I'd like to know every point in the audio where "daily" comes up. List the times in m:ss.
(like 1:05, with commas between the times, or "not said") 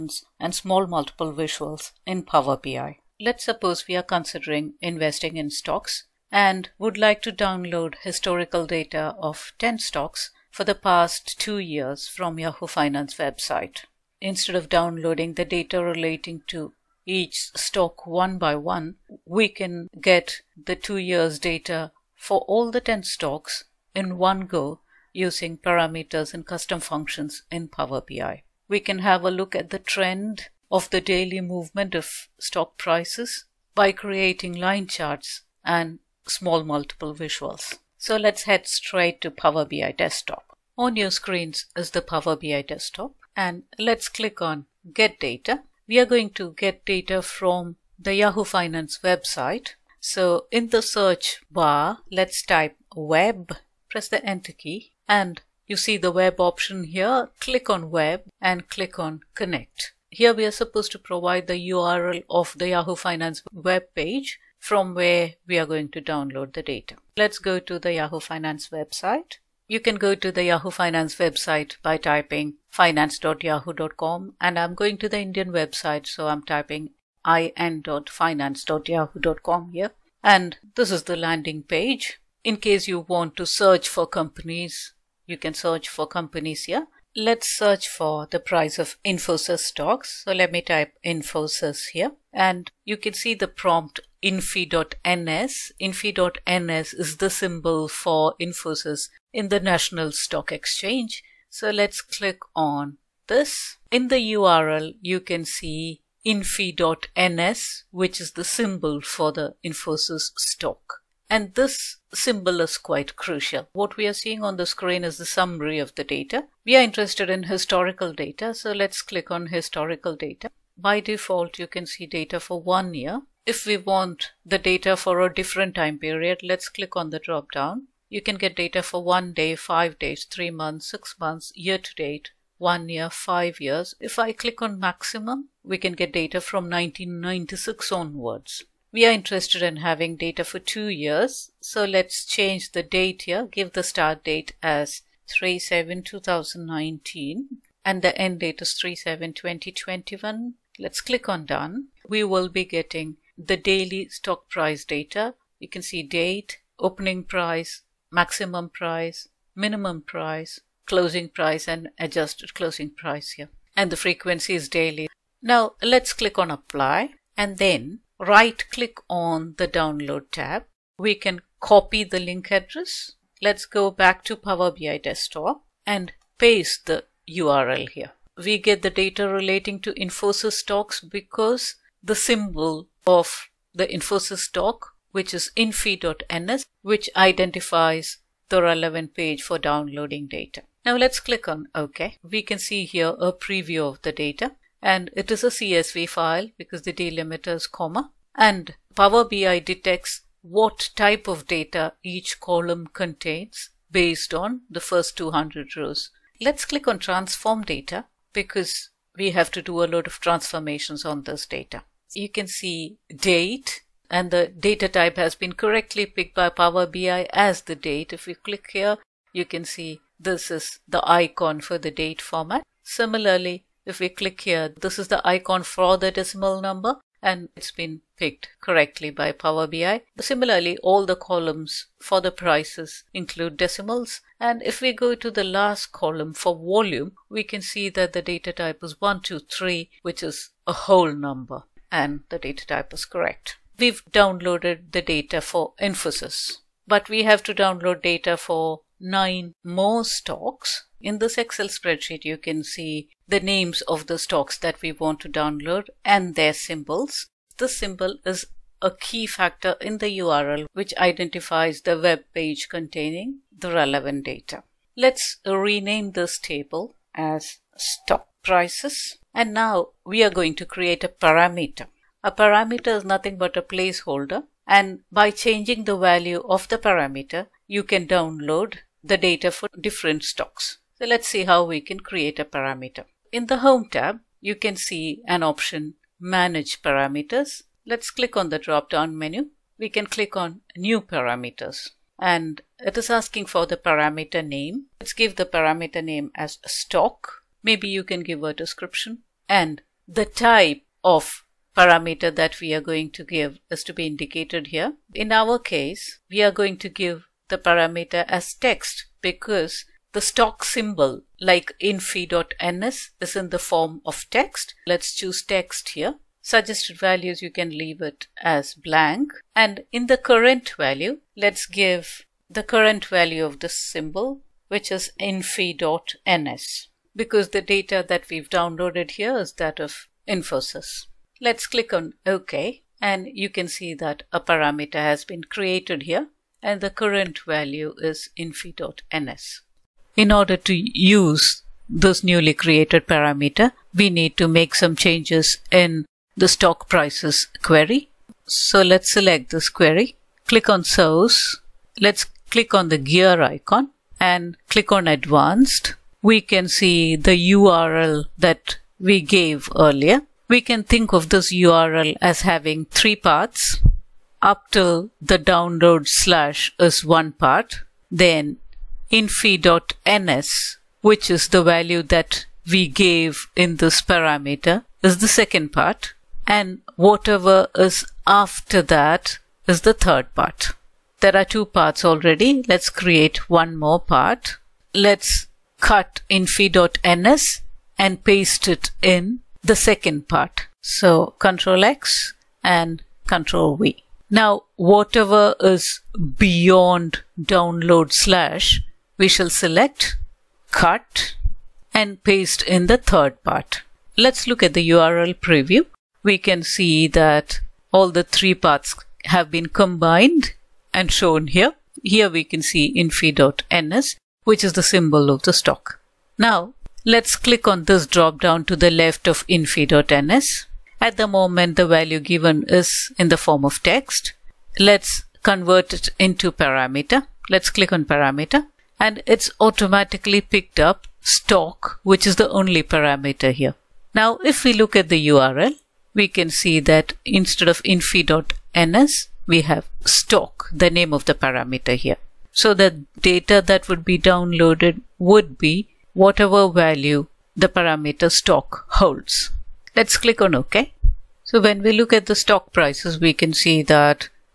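0:30, 2:33, 2:44.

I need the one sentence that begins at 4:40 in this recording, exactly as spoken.
So let's see how we can create a parameter.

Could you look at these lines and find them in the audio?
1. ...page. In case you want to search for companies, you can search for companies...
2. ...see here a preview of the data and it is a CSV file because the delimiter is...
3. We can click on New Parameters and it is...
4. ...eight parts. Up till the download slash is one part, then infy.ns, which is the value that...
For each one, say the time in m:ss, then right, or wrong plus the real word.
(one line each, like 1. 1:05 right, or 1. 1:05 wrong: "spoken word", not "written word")
1. 1:21 right
2. 3:12 right
3. 4:49 right
4. 6:02 wrong: "three", not "eight".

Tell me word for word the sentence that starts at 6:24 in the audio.
Let's cut infy.ns and paste it in the second part.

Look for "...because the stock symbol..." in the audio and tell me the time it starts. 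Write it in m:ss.
5:09.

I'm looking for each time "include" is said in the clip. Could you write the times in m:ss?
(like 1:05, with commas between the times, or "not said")
3:53.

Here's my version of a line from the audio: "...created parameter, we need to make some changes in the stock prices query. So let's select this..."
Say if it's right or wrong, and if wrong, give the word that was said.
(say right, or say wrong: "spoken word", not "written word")
right.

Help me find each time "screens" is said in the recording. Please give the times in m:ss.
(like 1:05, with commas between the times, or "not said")
0:41, 1:54.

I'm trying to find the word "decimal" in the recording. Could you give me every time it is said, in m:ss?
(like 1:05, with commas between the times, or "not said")
3:46, 3:53.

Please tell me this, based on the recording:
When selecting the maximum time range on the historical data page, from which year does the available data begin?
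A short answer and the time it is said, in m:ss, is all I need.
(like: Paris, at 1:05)
1996, at 2:16.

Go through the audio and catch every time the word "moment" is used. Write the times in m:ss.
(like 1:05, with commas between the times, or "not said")
7:01.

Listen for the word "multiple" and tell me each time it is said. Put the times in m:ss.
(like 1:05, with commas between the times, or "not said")
0:00, 0:36.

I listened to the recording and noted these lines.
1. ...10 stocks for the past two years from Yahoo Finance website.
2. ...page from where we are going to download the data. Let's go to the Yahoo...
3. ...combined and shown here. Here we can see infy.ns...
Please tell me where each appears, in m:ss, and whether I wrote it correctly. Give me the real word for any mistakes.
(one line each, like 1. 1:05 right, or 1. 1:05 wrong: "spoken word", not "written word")
1. 0:09 right
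2. 1:03 right
3. 6:49 right.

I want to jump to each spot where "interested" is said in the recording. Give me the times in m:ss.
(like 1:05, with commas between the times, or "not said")
1:56, 2:19.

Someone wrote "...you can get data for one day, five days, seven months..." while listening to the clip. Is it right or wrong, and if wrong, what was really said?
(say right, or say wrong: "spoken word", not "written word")
wrong: "three", not "seven".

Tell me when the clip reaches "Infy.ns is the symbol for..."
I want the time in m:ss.
1:35.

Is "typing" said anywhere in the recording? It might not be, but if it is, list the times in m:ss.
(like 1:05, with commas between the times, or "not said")
1:11, 1:16.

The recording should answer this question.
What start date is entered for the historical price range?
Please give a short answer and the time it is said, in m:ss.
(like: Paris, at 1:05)
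3-7-2019, at 2:25.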